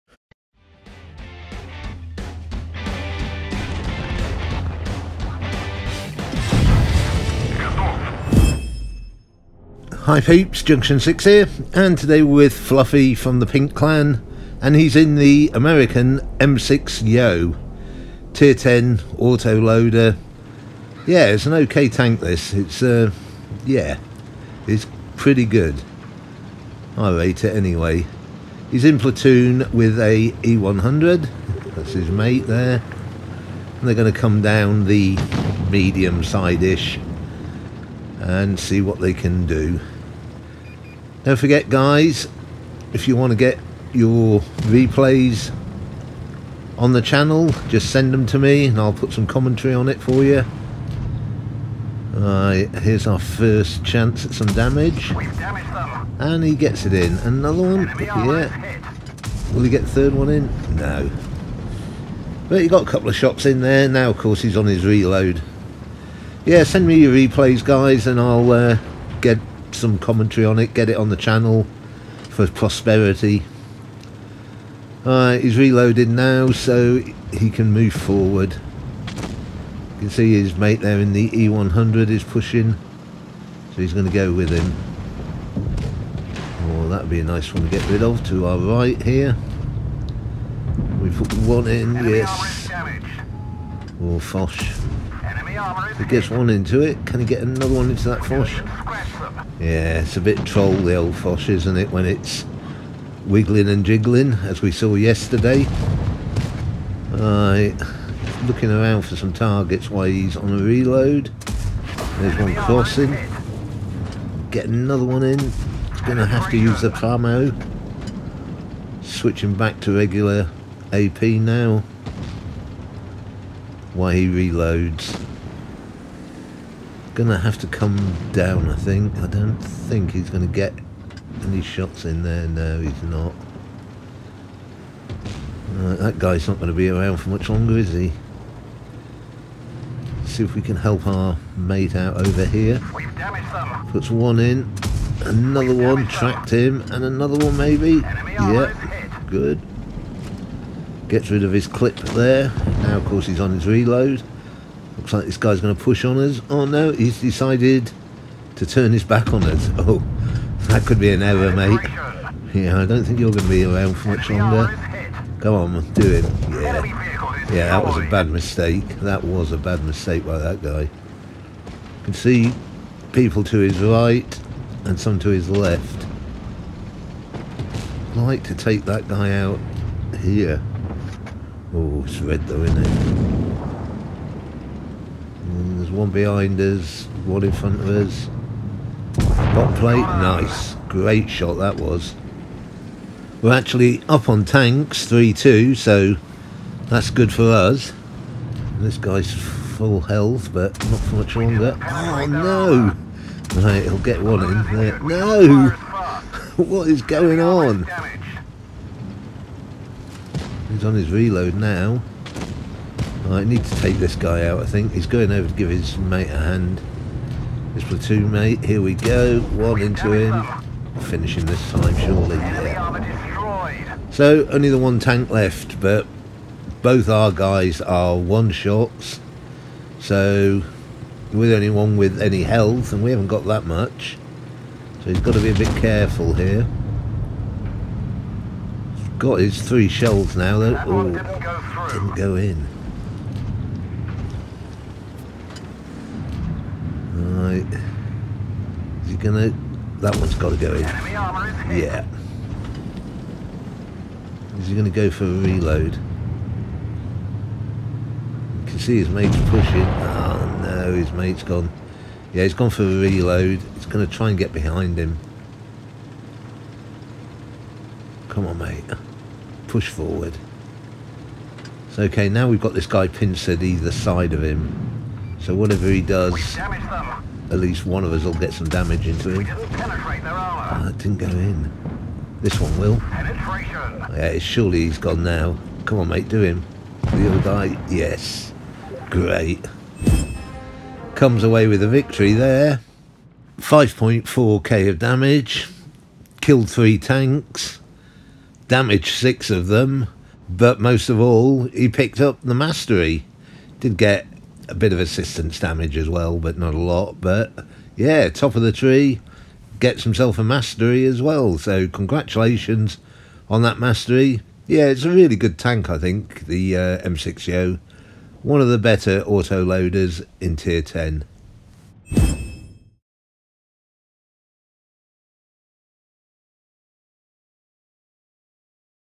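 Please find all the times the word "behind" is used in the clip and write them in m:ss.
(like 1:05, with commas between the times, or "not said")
3:06, 4:24.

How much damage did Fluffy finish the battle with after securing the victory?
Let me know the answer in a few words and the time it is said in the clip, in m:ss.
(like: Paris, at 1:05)
5.4k, at 4:53.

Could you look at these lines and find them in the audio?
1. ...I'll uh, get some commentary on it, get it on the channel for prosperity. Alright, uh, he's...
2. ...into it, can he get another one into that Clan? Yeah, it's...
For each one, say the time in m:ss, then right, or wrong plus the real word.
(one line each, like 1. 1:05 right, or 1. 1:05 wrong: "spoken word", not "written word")
1. 1:08 right
2. 1:36 wrong: "Foch", not "Clan".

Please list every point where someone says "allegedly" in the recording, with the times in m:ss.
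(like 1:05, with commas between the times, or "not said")
not said.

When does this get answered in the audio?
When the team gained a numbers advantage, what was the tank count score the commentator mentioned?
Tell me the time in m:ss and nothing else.
3:15.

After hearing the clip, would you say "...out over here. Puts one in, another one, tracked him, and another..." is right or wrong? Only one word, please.
right.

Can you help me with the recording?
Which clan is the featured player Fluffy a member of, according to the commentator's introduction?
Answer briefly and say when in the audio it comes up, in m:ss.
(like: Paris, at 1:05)
Pink Clan, at 0:13.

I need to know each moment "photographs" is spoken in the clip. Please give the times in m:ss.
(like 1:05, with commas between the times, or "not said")
not said.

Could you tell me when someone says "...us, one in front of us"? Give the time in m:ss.
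3:06.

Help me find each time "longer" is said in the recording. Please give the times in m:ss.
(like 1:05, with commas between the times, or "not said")
2:17, 2:44, 3:21.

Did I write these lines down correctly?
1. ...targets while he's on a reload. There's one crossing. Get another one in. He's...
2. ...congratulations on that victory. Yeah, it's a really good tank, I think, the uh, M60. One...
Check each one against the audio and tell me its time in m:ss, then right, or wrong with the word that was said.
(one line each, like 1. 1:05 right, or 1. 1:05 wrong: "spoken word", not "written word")
1. 1:49 right
2. 5:11 wrong: "mastery", not "victory".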